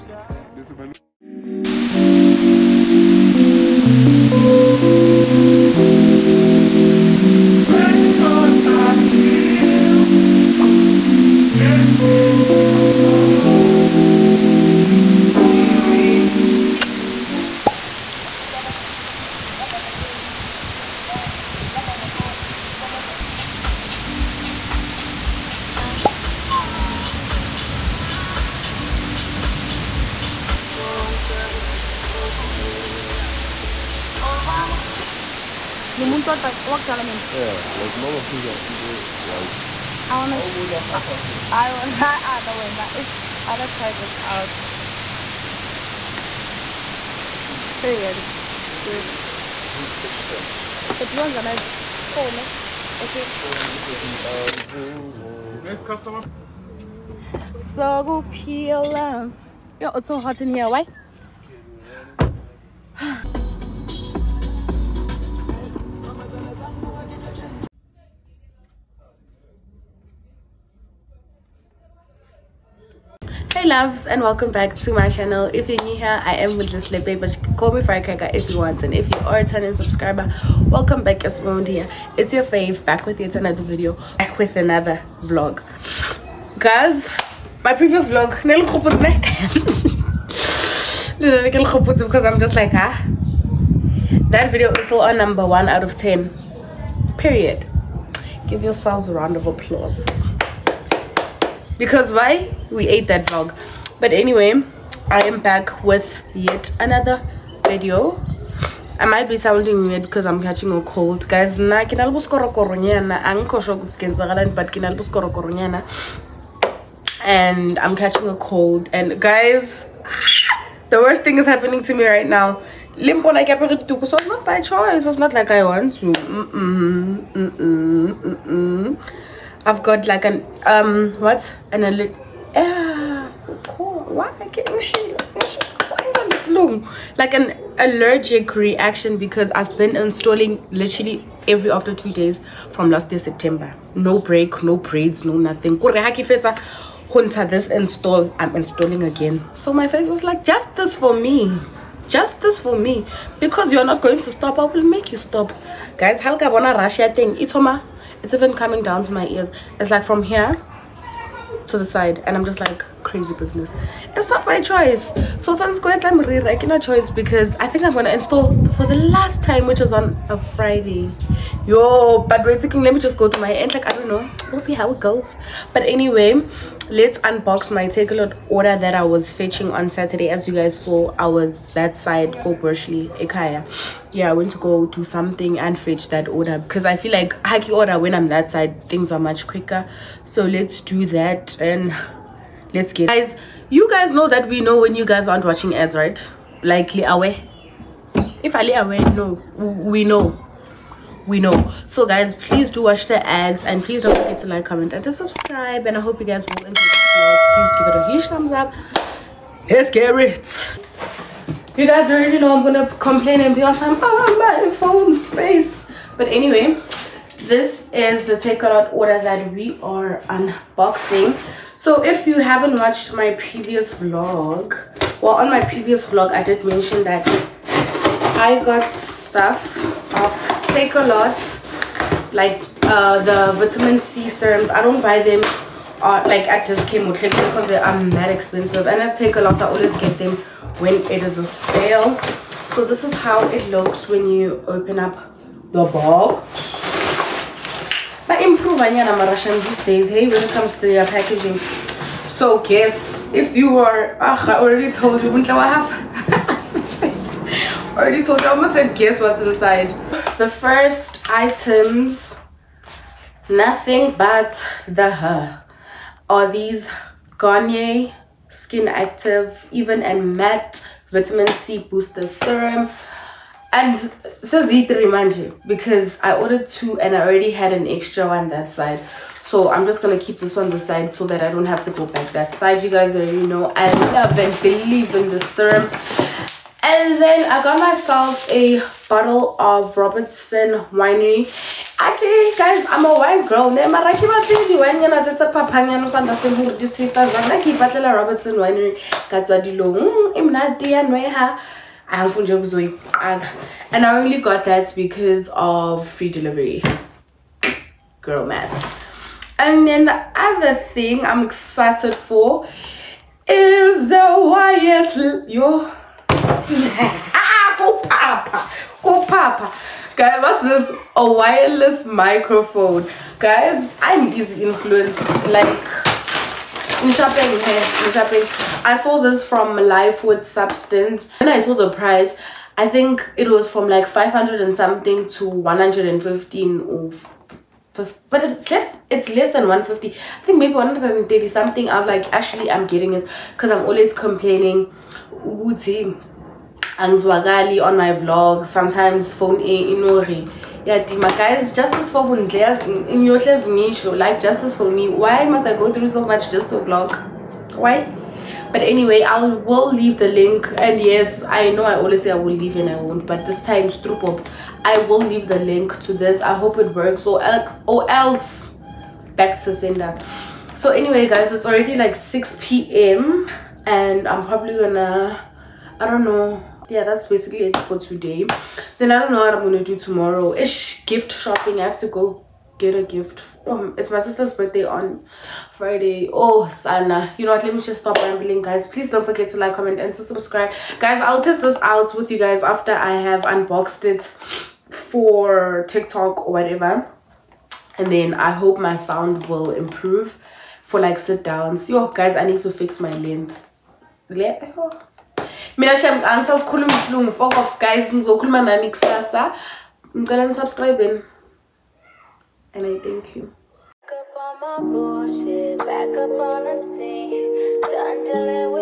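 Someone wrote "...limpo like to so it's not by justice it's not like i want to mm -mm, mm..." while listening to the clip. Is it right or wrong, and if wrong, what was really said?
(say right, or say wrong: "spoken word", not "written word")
wrong: "choice", not "justice".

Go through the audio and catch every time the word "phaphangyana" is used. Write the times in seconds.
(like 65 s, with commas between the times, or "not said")
295 s.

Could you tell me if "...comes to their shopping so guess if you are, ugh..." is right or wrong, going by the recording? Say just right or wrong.
wrong.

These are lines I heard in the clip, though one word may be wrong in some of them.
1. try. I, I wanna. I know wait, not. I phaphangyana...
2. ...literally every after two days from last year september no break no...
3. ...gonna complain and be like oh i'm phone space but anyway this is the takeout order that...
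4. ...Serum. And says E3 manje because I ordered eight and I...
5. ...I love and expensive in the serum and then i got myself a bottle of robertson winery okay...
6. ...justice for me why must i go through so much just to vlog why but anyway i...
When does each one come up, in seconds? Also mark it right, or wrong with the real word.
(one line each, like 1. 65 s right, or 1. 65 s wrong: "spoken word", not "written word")
1. 40 s wrong: "wanna", not "phaphangyana"
2. 140 s right
3. 212 s right
4. 272 s wrong: "two", not "eight"
5. 283 s wrong: "believe", not "expensive"
6. 354 s right.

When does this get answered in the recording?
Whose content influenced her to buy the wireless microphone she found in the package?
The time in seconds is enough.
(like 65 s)
329 s.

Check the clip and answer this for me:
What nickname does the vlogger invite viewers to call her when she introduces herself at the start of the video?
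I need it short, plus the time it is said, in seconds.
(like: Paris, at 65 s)
firecracker, at 77 s.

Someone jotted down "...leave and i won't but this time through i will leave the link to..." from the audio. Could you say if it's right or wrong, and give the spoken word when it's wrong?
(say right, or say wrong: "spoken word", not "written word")
right.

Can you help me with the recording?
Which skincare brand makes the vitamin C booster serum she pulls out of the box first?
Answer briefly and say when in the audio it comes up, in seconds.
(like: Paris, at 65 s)
Garnier, at 267 s.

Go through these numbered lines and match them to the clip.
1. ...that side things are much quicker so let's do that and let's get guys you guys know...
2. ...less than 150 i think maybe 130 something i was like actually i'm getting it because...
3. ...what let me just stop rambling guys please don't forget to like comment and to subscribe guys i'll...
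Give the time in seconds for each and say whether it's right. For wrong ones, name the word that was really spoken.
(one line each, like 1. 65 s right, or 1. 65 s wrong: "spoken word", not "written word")
1. 188 s right
2. 339 s right
3. 387 s right.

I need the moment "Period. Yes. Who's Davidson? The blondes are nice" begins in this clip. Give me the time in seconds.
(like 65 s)
47 s.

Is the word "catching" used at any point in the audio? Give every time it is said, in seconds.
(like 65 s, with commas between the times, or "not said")
110 s, 117 s.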